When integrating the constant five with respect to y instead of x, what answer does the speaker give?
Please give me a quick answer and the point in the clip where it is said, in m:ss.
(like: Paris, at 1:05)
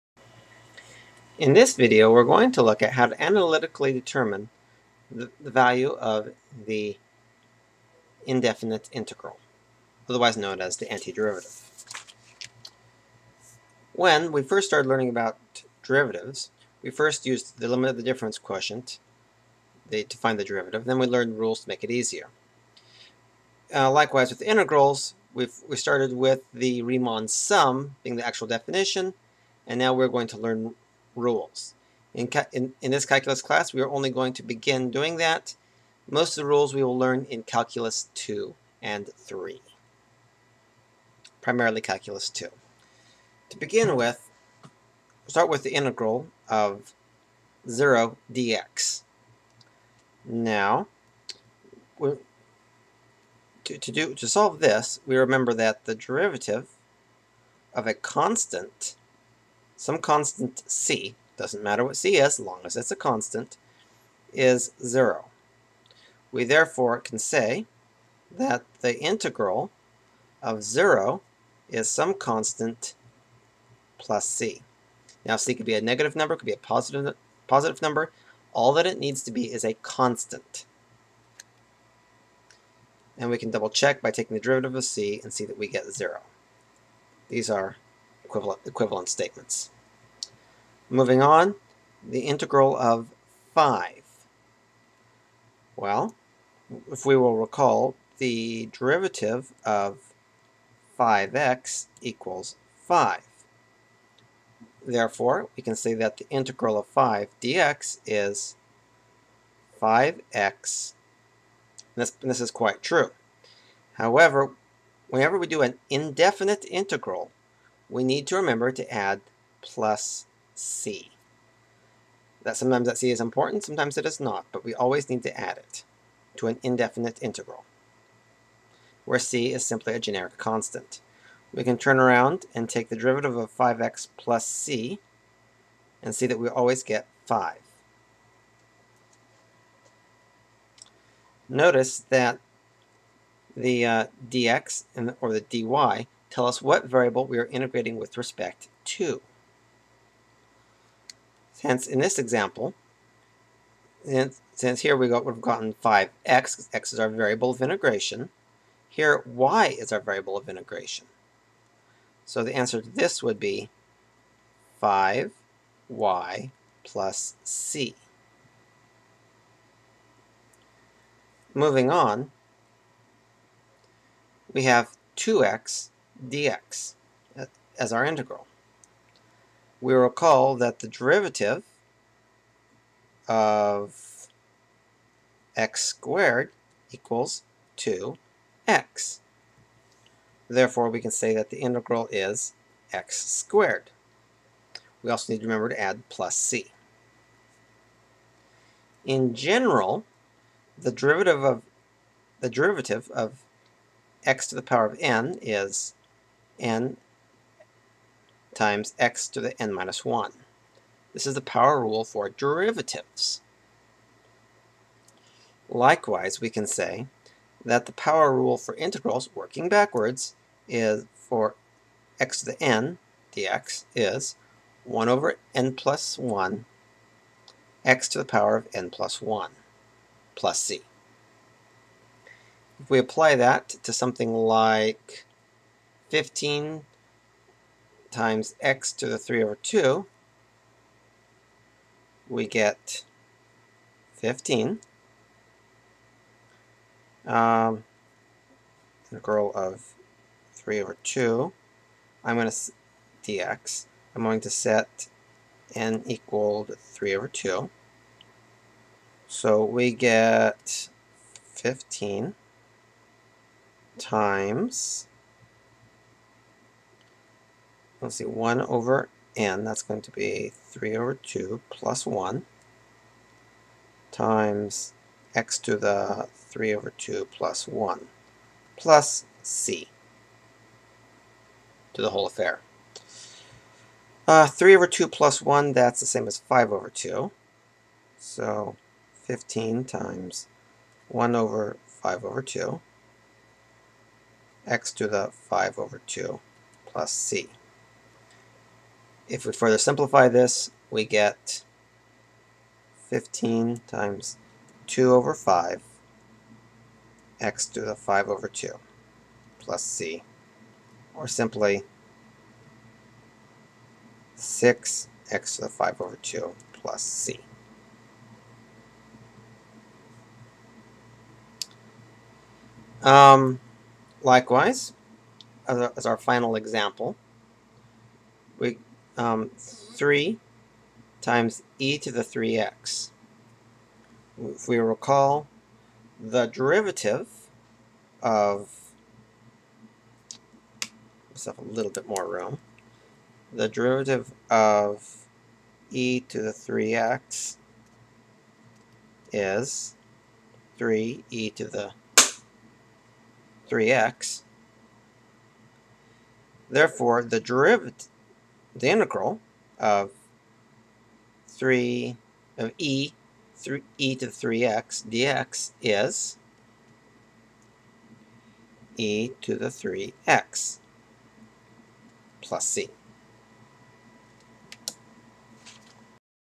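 5y plus c, at 2:44.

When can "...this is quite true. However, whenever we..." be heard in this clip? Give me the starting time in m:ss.
1:52.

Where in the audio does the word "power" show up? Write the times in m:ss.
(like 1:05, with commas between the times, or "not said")
3:24, 3:31, 3:37, 3:48.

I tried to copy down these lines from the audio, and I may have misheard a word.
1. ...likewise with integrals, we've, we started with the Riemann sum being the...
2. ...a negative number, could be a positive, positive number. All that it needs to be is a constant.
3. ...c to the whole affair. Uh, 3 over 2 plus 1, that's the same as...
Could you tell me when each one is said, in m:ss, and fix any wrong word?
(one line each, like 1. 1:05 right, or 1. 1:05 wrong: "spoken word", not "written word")
1. 0:23 right
2. 1:15 right
3. 4:39 right.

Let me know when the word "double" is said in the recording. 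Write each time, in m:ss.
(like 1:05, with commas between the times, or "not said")
1:23.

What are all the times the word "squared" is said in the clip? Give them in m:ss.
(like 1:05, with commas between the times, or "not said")
3:05, 3:13.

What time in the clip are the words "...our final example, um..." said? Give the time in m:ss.
5:26.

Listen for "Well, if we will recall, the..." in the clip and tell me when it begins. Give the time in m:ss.
1:35.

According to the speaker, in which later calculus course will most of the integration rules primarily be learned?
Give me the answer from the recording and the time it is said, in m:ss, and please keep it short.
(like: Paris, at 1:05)
Calculus 2, at 0:41.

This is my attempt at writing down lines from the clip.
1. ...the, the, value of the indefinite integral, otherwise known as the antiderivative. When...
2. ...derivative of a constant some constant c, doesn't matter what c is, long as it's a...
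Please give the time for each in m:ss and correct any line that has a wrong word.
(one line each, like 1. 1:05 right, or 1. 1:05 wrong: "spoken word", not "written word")
1. 0:05 right
2. 0:55 right.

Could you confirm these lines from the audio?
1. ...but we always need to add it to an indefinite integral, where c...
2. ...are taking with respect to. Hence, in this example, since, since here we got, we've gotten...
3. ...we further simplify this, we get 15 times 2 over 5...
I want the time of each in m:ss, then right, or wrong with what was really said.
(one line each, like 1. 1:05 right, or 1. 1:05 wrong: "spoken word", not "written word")
1. 2:04 right
2. 2:27 wrong: "integrating", not "taking"
3. 4:59 right.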